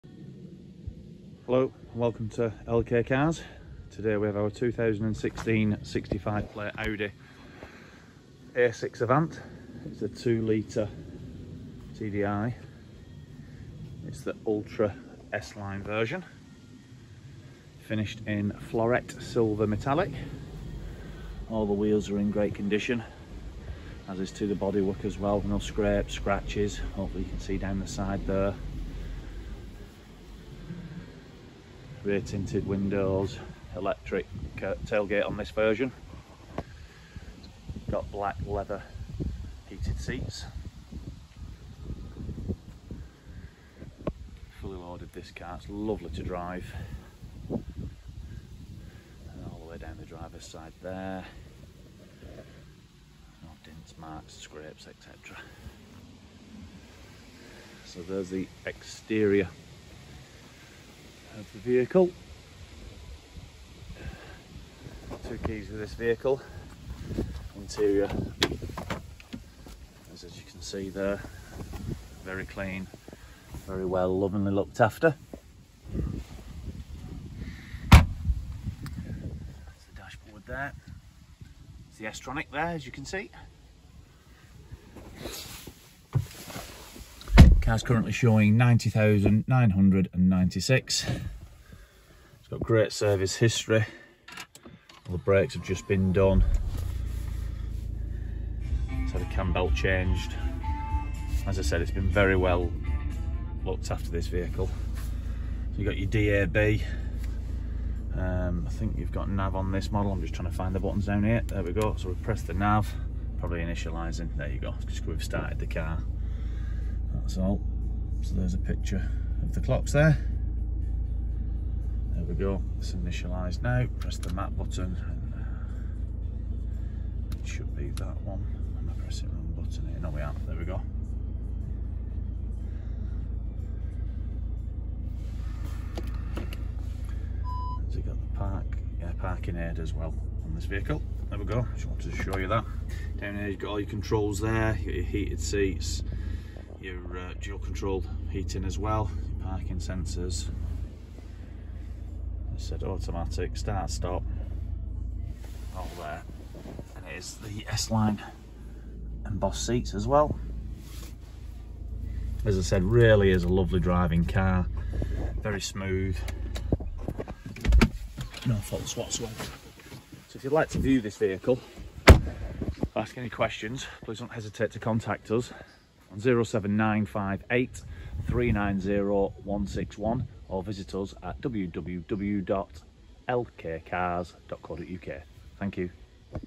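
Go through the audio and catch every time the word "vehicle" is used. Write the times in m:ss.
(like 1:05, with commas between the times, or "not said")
1:01, 1:05, 1:44, 2:20, 2:51.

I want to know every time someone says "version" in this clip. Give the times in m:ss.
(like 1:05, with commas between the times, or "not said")
0:15, 0:35.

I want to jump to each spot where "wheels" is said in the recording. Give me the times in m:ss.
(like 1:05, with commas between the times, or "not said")
0:21.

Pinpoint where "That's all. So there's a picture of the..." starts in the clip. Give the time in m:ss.
1:57.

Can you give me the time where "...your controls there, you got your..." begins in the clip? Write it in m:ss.
2:23.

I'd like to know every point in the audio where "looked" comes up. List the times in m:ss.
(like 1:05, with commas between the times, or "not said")
1:14, 1:43.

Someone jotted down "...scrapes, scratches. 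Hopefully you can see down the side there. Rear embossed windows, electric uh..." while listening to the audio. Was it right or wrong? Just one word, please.
wrong.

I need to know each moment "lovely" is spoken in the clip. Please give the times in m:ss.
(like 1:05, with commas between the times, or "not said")
0:45, 2:43.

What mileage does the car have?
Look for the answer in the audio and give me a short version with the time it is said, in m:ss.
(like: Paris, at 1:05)
90,996, at 1:28.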